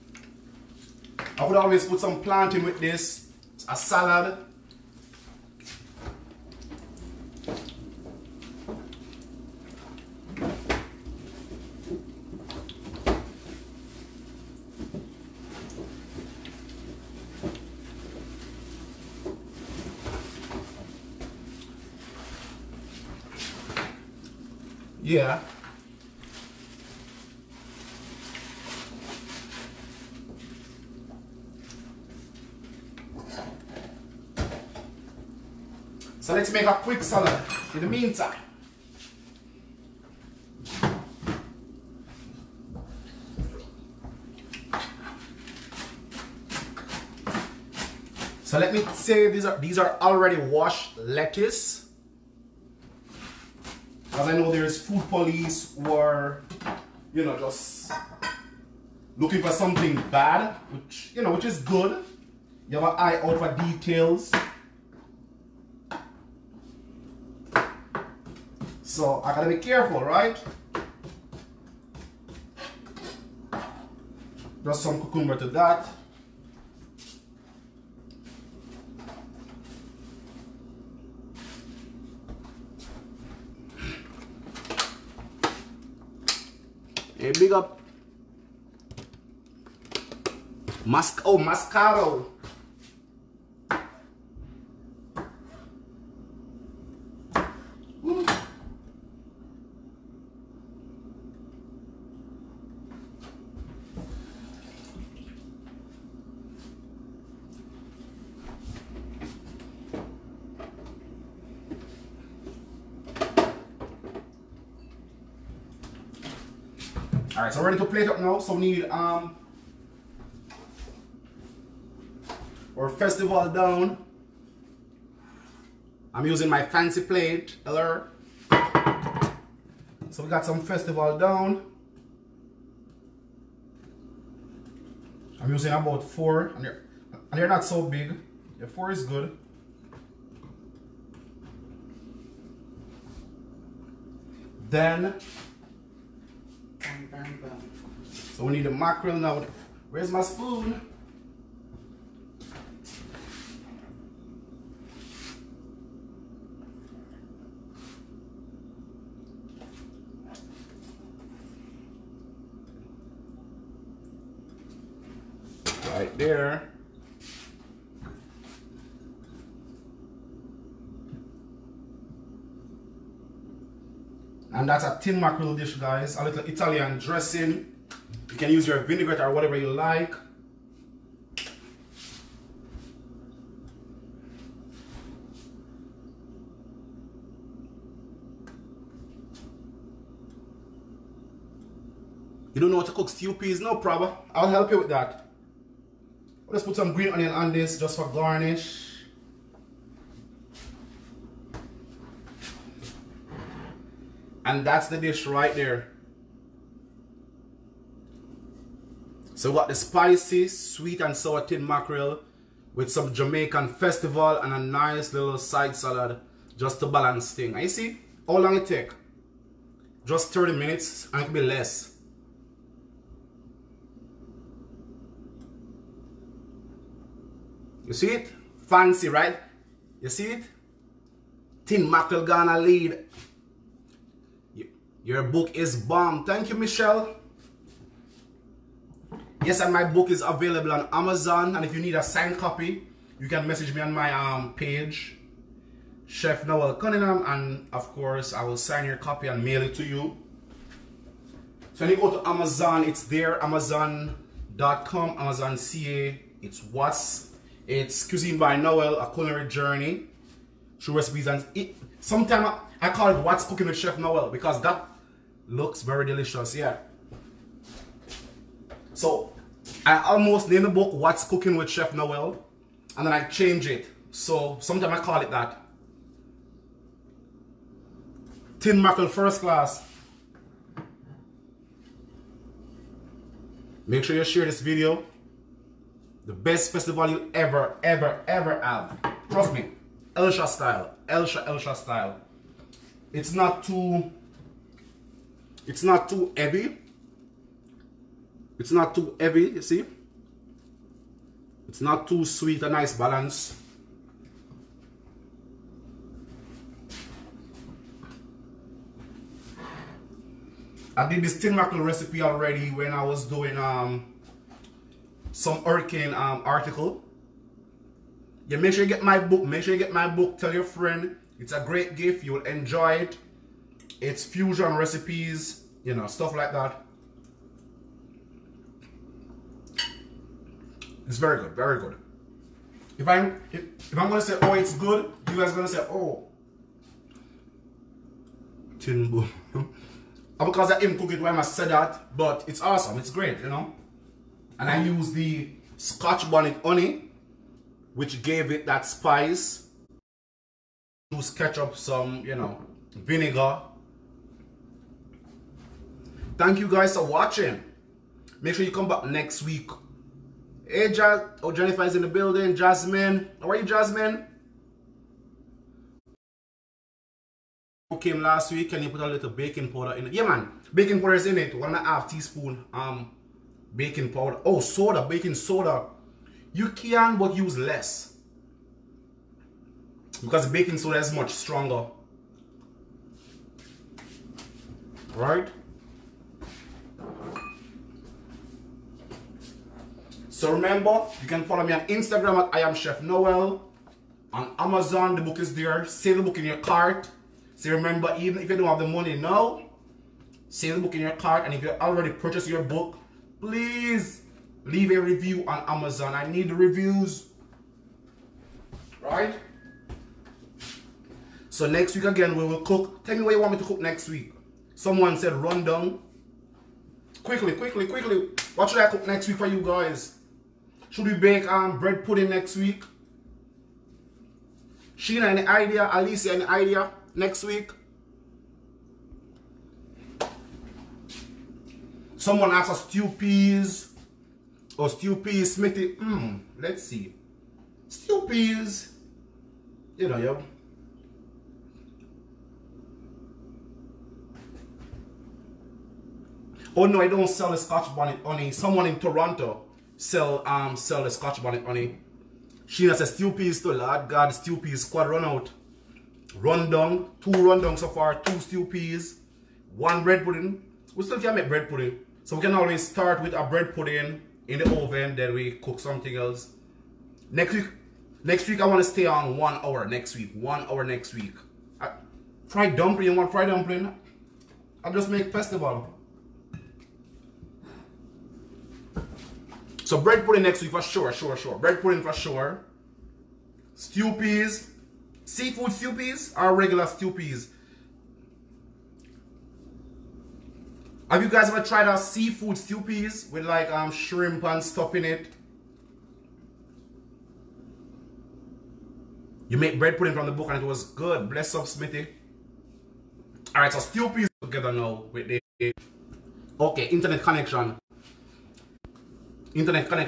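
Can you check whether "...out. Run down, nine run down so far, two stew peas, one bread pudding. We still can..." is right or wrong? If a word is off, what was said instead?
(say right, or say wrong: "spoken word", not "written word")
wrong: "two", not "nine".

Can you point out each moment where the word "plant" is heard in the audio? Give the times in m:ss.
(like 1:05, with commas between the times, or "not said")
0:02.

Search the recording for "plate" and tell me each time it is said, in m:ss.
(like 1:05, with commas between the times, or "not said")
1:57, 2:07.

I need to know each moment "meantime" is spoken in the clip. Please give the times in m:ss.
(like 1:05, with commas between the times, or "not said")
0:37.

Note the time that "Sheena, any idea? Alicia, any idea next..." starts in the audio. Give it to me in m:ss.
7:04.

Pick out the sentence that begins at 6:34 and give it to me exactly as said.
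On Amazon, the book is there.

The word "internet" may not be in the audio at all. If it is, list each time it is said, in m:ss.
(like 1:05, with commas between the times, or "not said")
8:26.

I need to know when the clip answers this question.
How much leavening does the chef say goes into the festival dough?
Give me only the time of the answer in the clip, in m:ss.
6:11.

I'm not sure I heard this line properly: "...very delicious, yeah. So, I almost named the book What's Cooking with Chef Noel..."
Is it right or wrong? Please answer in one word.
right.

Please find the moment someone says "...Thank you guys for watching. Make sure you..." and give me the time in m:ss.
5:56.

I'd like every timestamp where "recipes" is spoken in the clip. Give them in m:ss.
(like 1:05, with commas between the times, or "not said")
4:20, 5:11, 5:24.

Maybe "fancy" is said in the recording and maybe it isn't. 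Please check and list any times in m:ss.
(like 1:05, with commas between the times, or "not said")
2:06, 3:48.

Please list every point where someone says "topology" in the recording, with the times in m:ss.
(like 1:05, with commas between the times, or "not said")
not said.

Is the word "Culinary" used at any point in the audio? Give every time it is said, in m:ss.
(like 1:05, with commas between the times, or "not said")
4:19.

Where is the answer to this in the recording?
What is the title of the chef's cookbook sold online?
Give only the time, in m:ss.
4:18.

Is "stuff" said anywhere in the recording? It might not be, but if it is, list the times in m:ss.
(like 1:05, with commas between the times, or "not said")
5:26, 8:14.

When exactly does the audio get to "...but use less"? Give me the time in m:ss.
6:17.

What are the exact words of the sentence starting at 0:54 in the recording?
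As I know there's food police who are, you know, just looking for something bad, which you know, which is good.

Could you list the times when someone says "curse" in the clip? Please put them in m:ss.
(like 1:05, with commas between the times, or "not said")
not said.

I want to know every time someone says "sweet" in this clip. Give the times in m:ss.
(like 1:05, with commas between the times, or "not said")
3:30, 5:02.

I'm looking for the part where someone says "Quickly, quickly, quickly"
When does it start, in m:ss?
6:57.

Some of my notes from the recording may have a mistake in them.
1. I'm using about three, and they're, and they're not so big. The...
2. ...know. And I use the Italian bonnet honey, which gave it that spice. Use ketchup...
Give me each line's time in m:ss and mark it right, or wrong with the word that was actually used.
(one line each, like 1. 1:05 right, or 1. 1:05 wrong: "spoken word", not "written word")
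1. 2:15 wrong: "four", not "three"
2. 5:43 wrong: "Scotch", not "Italian".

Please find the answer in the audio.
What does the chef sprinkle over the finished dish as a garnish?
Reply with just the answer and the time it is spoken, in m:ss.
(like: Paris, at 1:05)
green onion, at 3:16.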